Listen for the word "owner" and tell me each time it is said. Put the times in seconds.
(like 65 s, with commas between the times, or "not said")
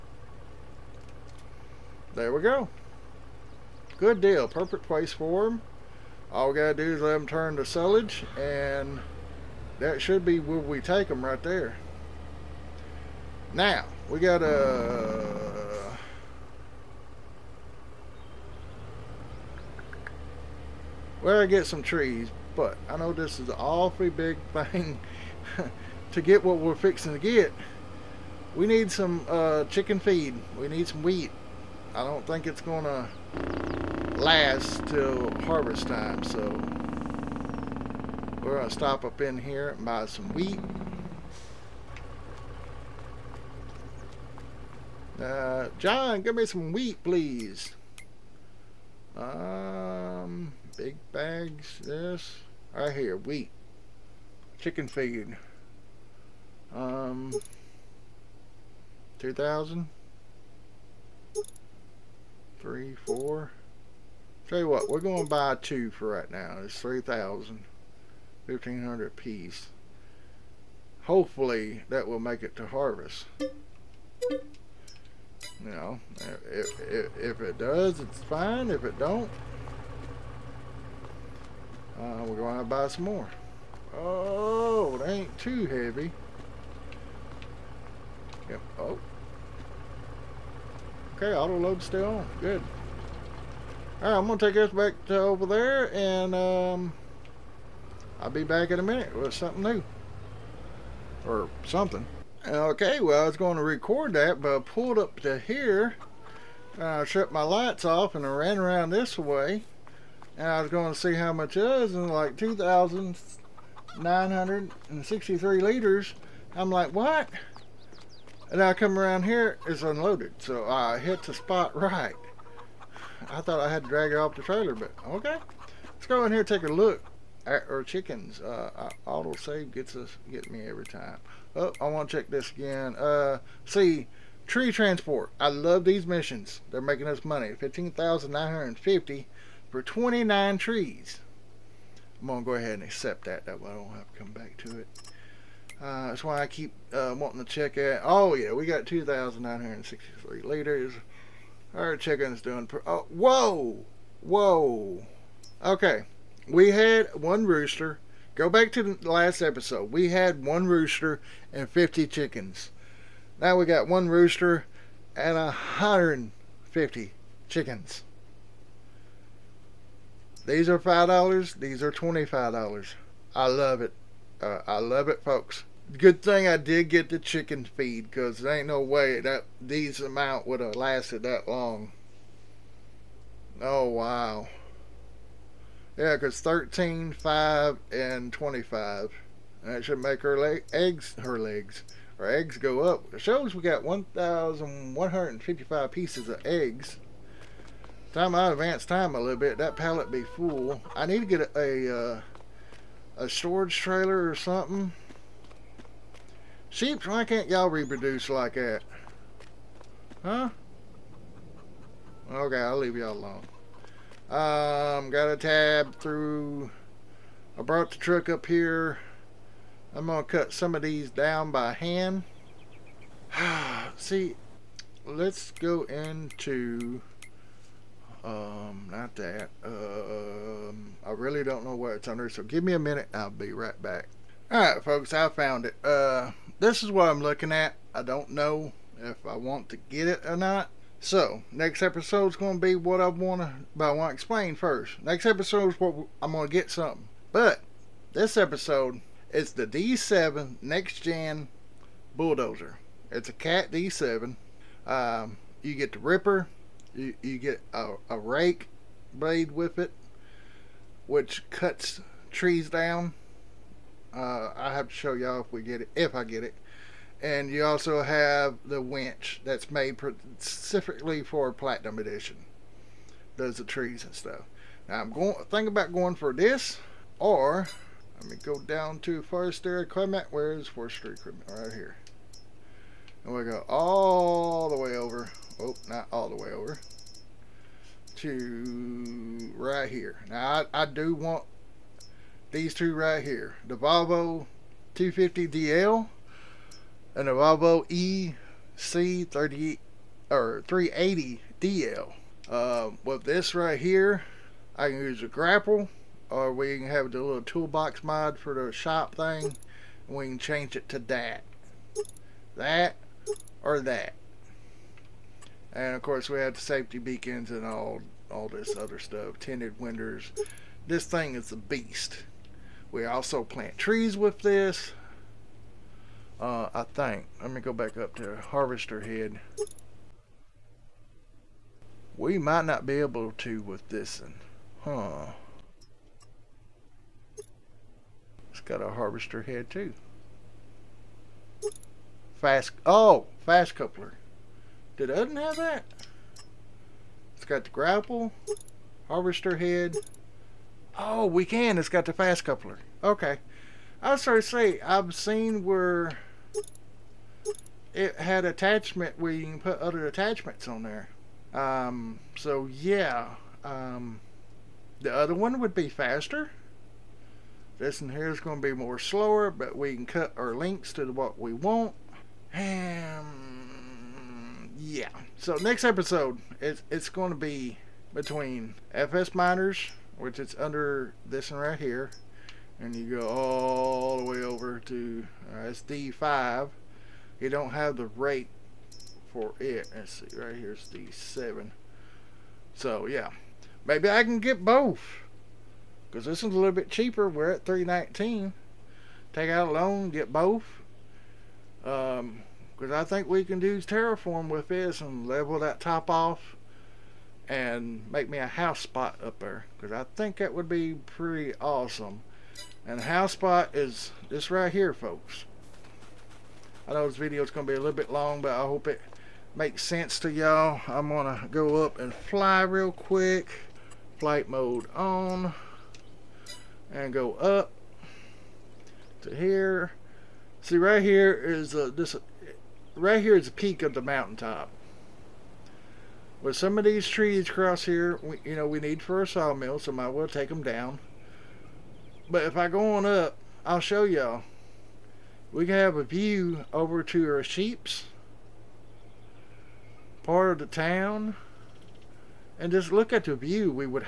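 not said.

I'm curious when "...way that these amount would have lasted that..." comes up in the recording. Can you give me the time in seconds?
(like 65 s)
178 s.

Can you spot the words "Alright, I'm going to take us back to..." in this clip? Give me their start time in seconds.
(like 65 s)
93 s.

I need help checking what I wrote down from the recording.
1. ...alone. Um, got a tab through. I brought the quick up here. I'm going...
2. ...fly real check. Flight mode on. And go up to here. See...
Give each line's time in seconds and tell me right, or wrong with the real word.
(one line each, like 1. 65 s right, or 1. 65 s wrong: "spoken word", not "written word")
1. 213 s wrong: "truck", not "quick"
2. 422 s wrong: "quick", not "check".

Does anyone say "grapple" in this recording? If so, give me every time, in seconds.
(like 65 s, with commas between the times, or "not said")
305 s, 347 s.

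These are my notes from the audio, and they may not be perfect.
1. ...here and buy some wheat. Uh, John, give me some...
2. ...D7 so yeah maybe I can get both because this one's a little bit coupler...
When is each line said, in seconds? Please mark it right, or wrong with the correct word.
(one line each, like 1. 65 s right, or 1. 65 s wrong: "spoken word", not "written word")
1. 39 s right
2. 390 s wrong: "cheaper", not "coupler".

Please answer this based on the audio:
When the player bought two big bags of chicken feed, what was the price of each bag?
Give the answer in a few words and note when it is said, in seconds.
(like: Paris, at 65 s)
1,500, at 68 s.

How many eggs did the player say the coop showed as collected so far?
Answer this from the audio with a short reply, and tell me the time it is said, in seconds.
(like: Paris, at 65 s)
1,155, at 193 s.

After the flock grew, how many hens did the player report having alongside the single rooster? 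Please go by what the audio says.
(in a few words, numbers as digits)
150.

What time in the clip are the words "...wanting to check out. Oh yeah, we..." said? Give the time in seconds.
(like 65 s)
147 s.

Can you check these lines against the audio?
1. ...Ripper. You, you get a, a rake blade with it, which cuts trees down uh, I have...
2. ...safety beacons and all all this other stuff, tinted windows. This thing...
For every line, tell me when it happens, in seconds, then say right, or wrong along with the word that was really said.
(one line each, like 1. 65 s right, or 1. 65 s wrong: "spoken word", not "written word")
1. 255 s right
2. 316 s right.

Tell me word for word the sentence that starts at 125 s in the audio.
Let's go in here take a look at our chickens.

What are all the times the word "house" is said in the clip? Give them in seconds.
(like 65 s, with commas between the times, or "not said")
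408 s, 413 s.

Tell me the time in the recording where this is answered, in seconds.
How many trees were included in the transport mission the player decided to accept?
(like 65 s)
139 s.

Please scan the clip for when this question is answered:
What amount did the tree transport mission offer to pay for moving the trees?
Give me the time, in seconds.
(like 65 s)
137 s.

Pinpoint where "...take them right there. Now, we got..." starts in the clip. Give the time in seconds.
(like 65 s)
10 s.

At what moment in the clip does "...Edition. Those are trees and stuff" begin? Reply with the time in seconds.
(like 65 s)
271 s.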